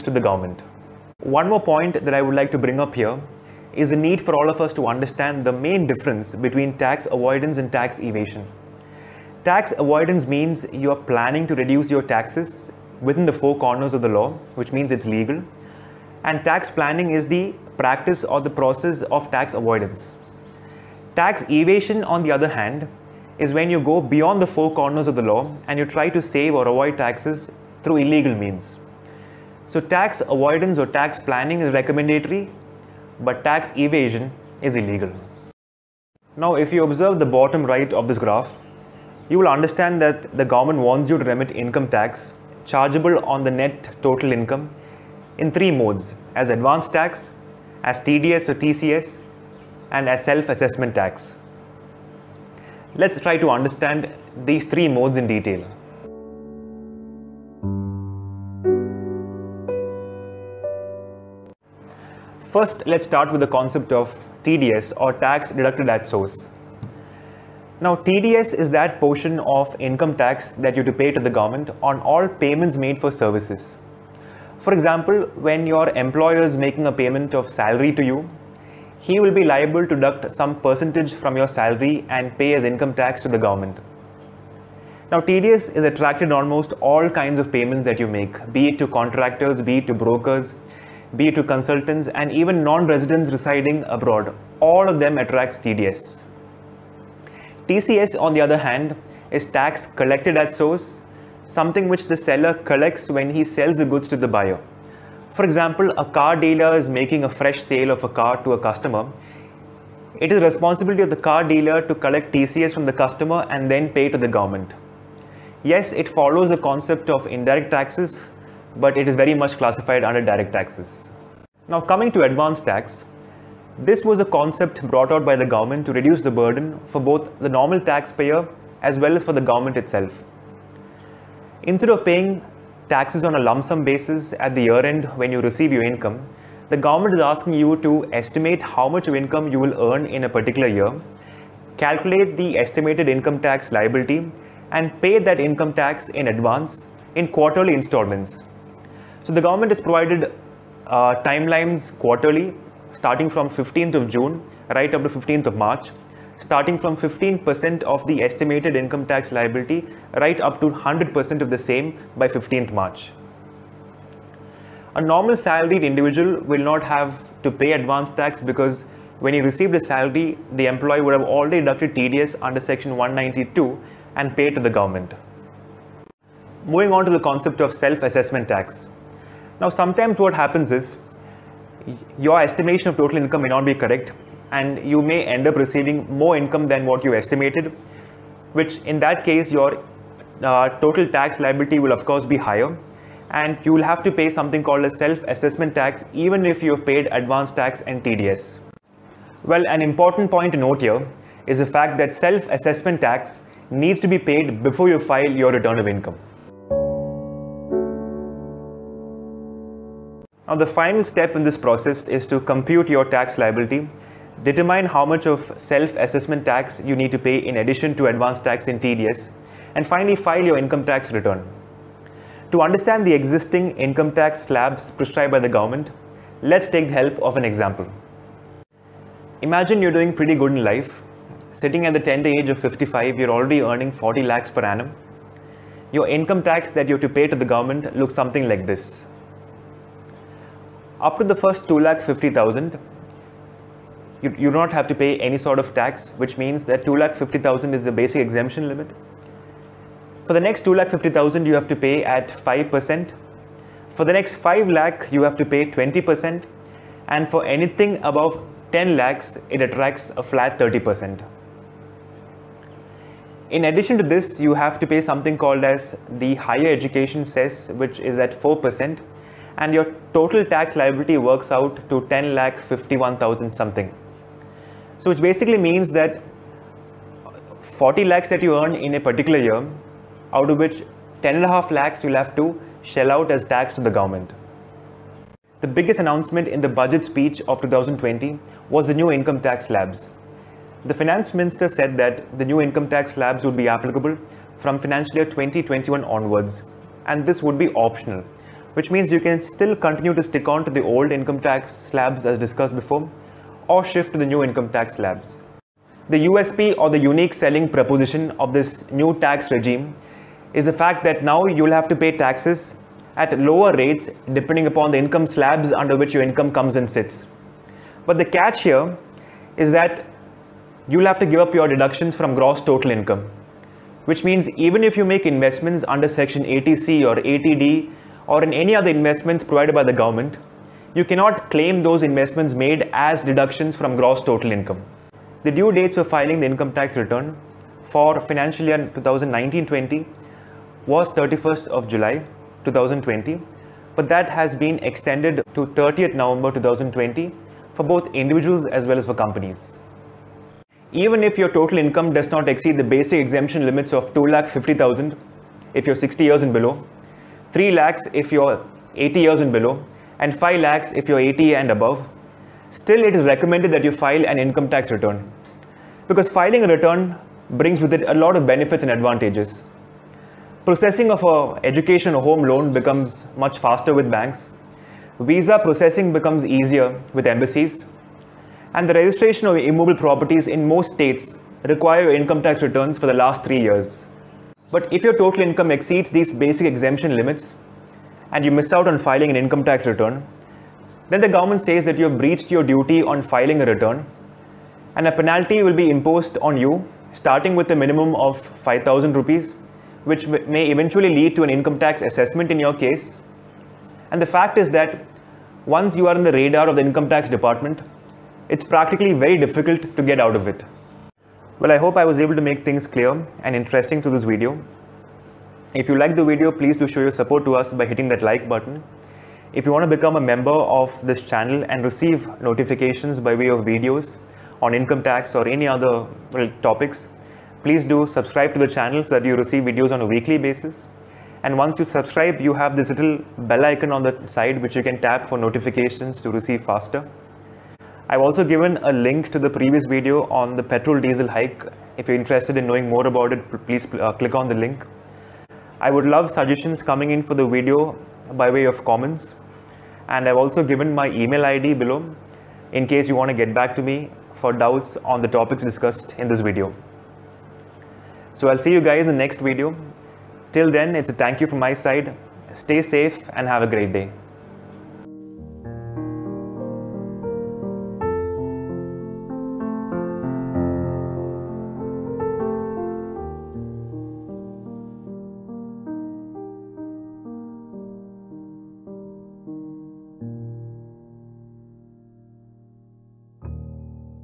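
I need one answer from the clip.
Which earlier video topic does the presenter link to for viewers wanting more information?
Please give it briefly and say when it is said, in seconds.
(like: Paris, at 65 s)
petrol diesel hike, at 440 s.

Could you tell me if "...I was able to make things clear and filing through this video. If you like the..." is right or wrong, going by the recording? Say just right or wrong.
wrong.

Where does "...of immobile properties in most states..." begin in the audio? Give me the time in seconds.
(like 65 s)
379 s.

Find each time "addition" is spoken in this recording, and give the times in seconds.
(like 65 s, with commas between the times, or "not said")
217 s, 263 s.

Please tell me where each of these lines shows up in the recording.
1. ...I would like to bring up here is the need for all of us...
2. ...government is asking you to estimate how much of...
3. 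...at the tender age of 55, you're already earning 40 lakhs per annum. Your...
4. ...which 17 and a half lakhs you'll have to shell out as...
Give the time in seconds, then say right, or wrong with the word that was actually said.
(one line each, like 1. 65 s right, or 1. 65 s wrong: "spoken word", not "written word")
1. 2 s right
2. 136 s right
3. 231 s right
4. 280 s wrong: "10", not "17".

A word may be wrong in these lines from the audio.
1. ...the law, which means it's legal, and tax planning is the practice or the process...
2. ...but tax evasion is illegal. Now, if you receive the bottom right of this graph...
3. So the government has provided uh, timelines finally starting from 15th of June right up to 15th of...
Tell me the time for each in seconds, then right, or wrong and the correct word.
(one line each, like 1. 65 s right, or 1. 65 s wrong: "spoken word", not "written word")
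1. 14 s right
2. 33 s wrong: "observe", not "receive"
3. 149 s wrong: "quarterly", not "finally".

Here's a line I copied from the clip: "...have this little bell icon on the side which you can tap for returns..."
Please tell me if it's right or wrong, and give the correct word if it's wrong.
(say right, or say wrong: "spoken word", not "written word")
wrong: "notifications", not "returns".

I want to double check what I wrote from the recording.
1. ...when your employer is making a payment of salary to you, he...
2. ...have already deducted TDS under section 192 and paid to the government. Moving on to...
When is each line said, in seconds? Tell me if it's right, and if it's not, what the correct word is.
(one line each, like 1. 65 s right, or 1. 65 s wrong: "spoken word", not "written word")
1. 75 s right
2. 171 s right.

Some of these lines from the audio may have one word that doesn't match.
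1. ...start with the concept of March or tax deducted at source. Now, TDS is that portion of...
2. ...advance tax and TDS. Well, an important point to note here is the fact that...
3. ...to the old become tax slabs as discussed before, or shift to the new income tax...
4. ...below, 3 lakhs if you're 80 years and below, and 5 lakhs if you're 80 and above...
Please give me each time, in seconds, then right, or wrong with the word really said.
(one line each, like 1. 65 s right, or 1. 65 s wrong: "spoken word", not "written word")
1. 63 s wrong: "TDS", not "March"
2. 197 s right
3. 300 s wrong: "income", not "become"
4. 356 s right.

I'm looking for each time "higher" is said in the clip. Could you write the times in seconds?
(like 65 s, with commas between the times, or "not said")
192 s, 266 s.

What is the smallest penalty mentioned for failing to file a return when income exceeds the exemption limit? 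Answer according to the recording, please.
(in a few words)
5000 rupees.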